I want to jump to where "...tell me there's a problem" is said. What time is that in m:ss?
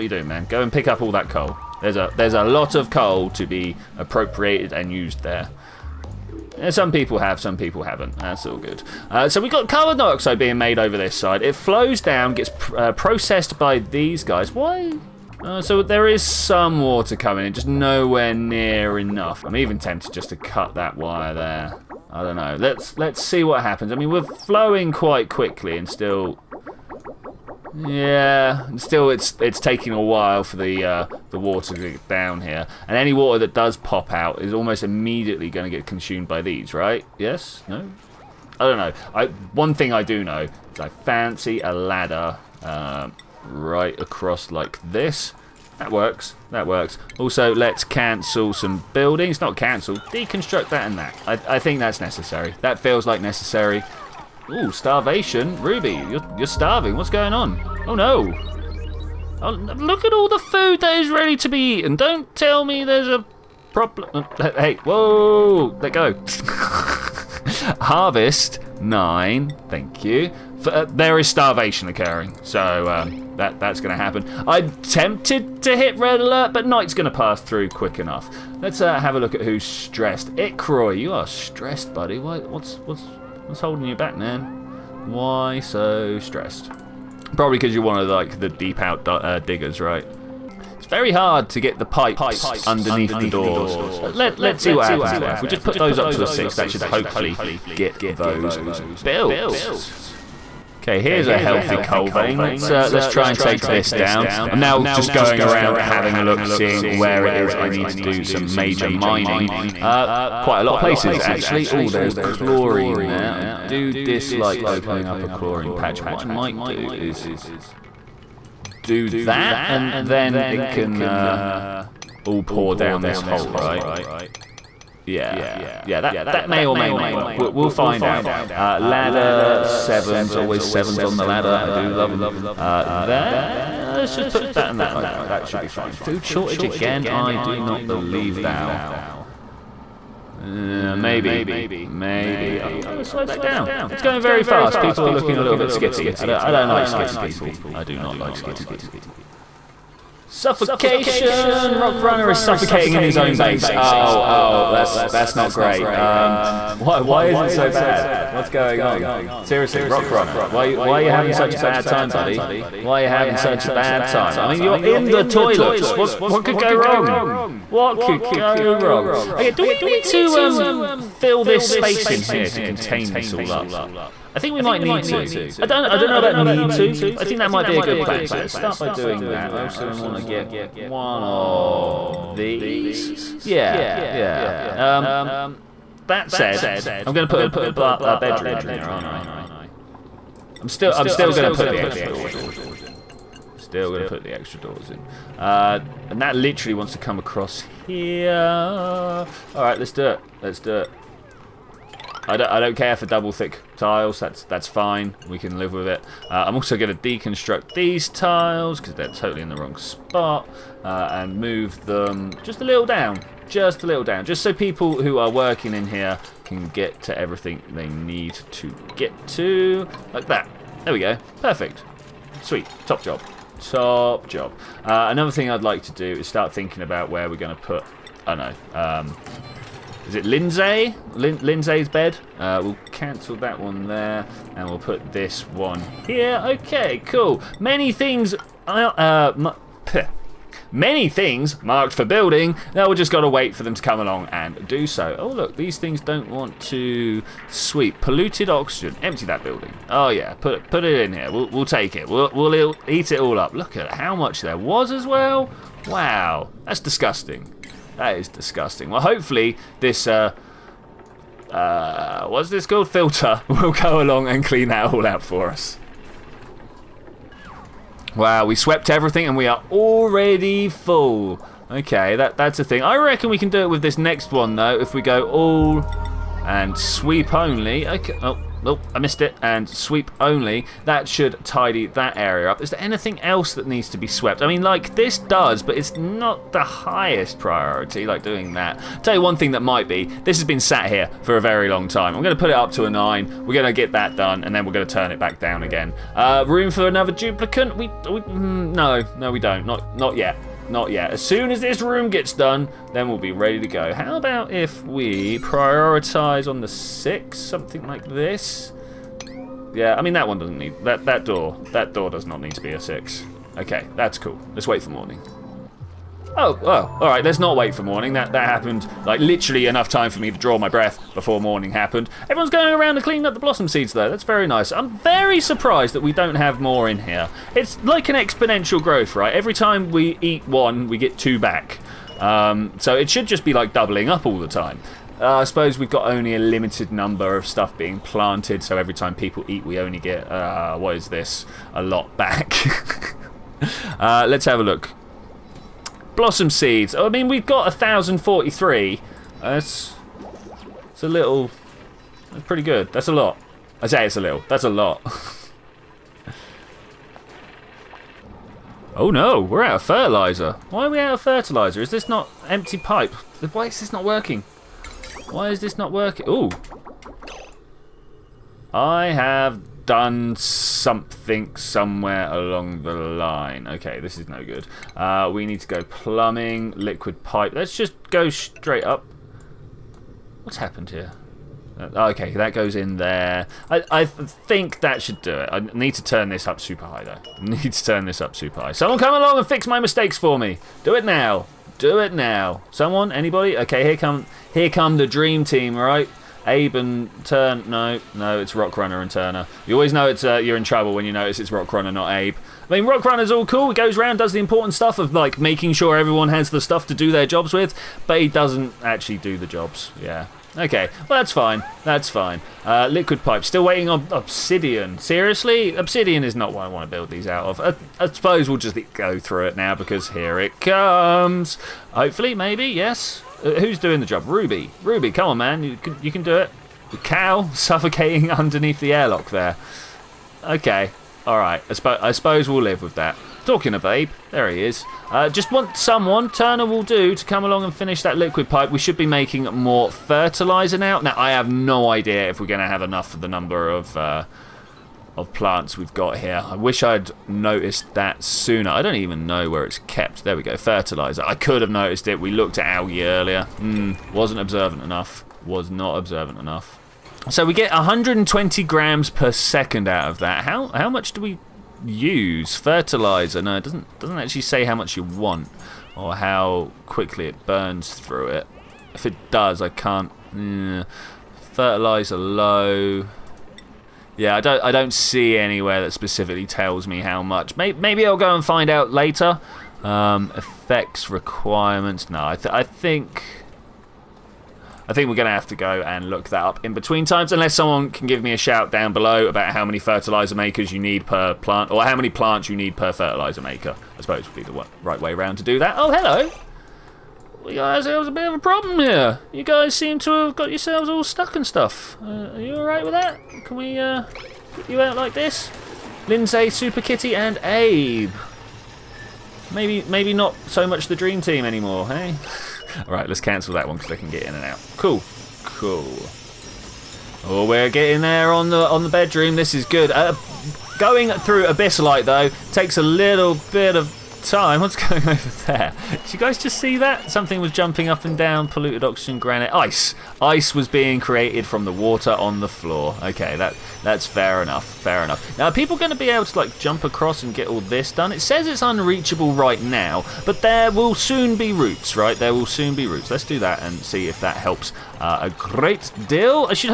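1:02.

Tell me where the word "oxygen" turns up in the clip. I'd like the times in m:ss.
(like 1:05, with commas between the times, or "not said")
4:08, 8:48.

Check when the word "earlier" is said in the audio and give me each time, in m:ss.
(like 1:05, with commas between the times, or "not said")
7:33.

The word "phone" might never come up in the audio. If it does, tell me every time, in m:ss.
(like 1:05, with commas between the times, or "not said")
not said.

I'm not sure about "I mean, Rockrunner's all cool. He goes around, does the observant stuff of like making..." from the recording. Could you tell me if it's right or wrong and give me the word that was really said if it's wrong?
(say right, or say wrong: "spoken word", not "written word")
wrong: "important", not "observant".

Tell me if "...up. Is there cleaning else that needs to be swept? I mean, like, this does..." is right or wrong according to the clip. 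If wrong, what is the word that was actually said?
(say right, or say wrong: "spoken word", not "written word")
wrong: "anything", not "cleaning".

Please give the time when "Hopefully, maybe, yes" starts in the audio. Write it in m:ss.
7:01.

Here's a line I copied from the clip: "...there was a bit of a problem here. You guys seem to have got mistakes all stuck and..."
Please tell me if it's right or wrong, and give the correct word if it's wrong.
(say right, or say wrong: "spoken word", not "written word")
wrong: "yourselves", not "mistakes".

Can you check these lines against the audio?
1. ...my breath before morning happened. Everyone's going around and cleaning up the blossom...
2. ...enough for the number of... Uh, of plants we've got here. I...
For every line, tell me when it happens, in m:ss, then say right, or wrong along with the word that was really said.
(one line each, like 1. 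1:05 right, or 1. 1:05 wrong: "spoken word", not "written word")
1. 5:20 right
2. 7:22 right.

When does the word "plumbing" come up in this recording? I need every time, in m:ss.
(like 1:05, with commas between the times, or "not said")
6:15.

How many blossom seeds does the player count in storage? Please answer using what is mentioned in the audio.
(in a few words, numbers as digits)
1,043.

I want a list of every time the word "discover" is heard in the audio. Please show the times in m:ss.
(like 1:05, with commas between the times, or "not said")
not said.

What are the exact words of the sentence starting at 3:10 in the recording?
I'm still, I'm still going to put the extra doors in.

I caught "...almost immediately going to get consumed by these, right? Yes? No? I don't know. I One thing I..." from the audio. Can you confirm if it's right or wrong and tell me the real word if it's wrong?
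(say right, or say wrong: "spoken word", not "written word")
right.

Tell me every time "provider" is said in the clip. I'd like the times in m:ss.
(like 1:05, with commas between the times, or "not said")
not said.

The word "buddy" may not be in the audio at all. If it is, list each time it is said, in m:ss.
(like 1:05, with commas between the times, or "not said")
1:21, 2:42.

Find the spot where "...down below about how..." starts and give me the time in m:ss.
8:08.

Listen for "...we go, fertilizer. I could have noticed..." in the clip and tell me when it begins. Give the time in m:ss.
7:30.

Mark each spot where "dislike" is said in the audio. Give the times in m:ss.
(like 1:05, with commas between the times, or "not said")
1:53.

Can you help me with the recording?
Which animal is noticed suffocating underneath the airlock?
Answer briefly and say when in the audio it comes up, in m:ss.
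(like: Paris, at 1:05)
cow, at 7:06.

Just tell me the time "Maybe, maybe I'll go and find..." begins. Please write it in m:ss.
7:57.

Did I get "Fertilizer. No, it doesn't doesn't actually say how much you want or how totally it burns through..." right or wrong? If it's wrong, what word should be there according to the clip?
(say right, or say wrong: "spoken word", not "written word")
wrong: "quickly", not "totally".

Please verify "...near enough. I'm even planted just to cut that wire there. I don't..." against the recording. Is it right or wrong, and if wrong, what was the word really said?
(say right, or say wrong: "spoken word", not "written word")
wrong: "tempted", not "planted".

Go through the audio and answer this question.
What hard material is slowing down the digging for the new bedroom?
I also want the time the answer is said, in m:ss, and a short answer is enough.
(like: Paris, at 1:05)
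Abyssalite, at 8:41.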